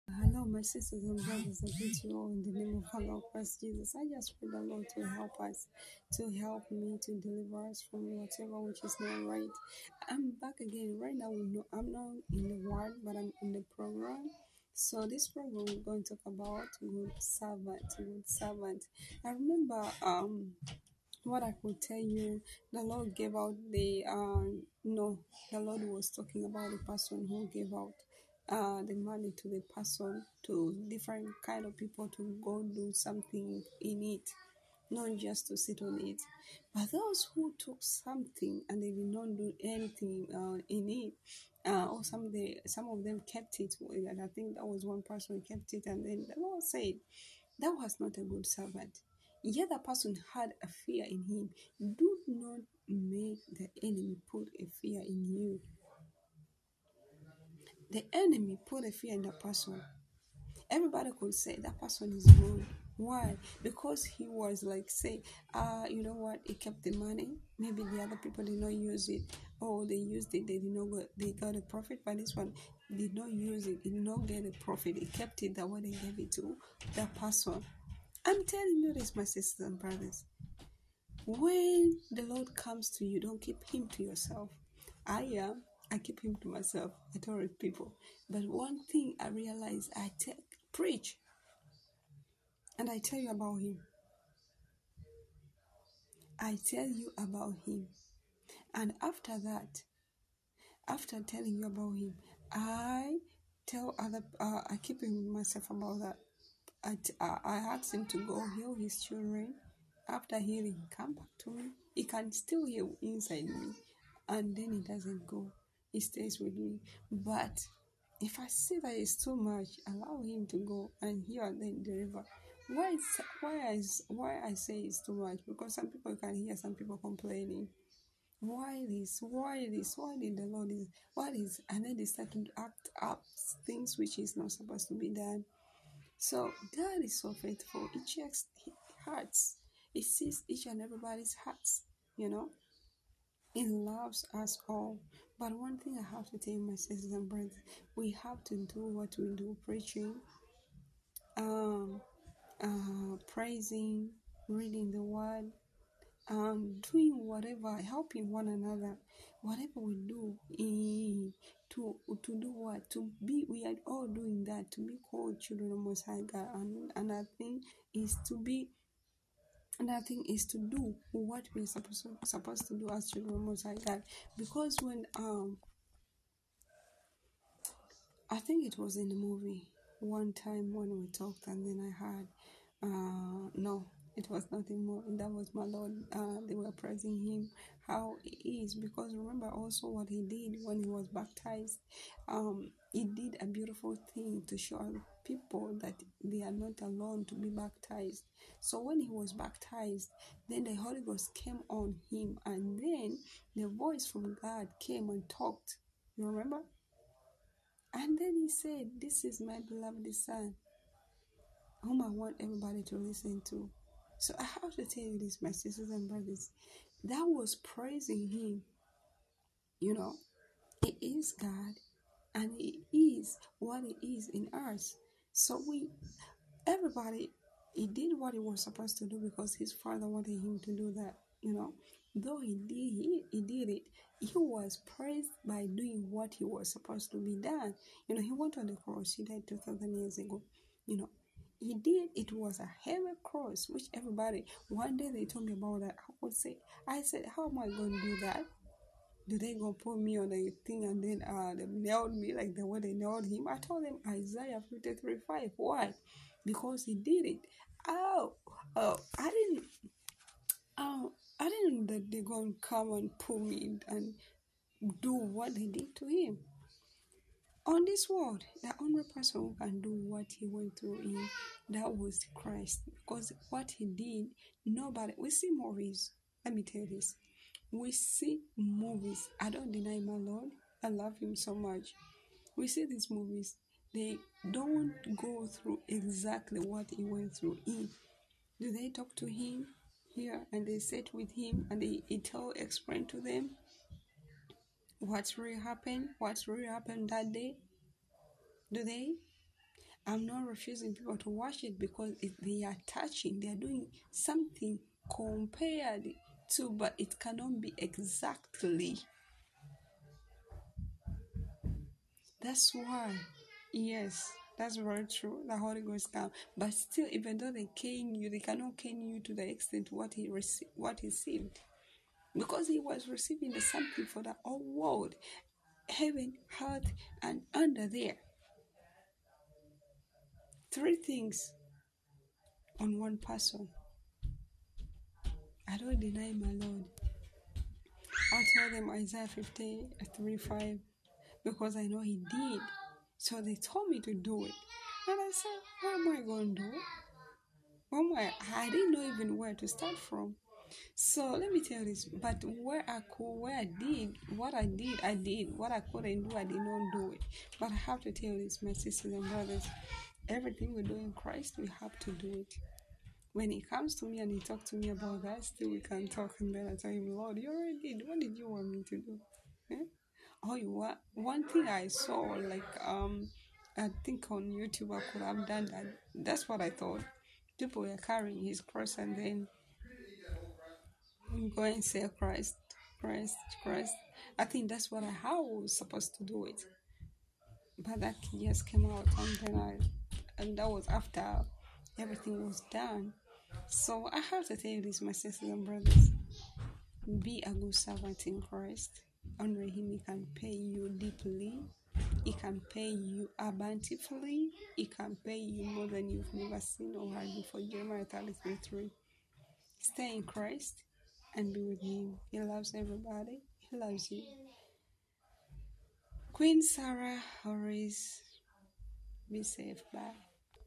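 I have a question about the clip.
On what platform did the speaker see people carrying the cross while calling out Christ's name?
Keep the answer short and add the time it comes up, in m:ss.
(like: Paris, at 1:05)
YouTube, at 6:14.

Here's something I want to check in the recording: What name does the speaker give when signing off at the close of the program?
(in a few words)
Queen Sarah Horace.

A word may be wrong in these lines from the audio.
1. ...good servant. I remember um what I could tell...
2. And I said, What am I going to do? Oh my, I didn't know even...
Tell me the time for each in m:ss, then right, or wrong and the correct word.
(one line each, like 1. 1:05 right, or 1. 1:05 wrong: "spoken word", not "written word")
1. 0:17 right
2. 5:45 right.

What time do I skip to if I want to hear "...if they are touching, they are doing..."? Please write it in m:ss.
5:02.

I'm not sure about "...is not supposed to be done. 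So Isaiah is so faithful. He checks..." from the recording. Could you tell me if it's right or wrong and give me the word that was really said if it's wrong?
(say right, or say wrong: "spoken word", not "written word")
wrong: "God", not "Isaiah".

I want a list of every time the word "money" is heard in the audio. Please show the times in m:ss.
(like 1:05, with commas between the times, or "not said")
0:28, 1:06.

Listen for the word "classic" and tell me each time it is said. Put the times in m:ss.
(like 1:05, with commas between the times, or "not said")
not said.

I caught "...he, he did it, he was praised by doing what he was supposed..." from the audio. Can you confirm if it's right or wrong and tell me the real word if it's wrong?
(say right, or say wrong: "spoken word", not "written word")
right.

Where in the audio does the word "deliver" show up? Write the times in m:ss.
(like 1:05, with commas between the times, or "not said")
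0:07, 2:01.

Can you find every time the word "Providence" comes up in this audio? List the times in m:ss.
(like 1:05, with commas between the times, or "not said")
not said.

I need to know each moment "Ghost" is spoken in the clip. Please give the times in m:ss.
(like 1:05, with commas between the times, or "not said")
3:21, 5:15.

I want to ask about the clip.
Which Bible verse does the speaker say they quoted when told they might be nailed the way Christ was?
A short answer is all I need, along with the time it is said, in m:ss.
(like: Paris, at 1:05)
Isaiah 53:5, at 4:14.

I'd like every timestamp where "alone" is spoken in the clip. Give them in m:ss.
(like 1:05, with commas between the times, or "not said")
3:16.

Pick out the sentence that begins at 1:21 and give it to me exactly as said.
When the Lord comes to you, don't keep him to yourself.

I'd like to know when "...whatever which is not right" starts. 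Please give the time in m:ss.
0:08.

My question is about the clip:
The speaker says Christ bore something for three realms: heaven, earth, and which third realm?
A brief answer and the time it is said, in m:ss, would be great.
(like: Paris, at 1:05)
under there, at 5:27.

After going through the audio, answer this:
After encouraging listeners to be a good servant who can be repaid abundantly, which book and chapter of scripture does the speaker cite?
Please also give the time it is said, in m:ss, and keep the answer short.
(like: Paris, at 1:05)
Jeremiah 33, at 6:47.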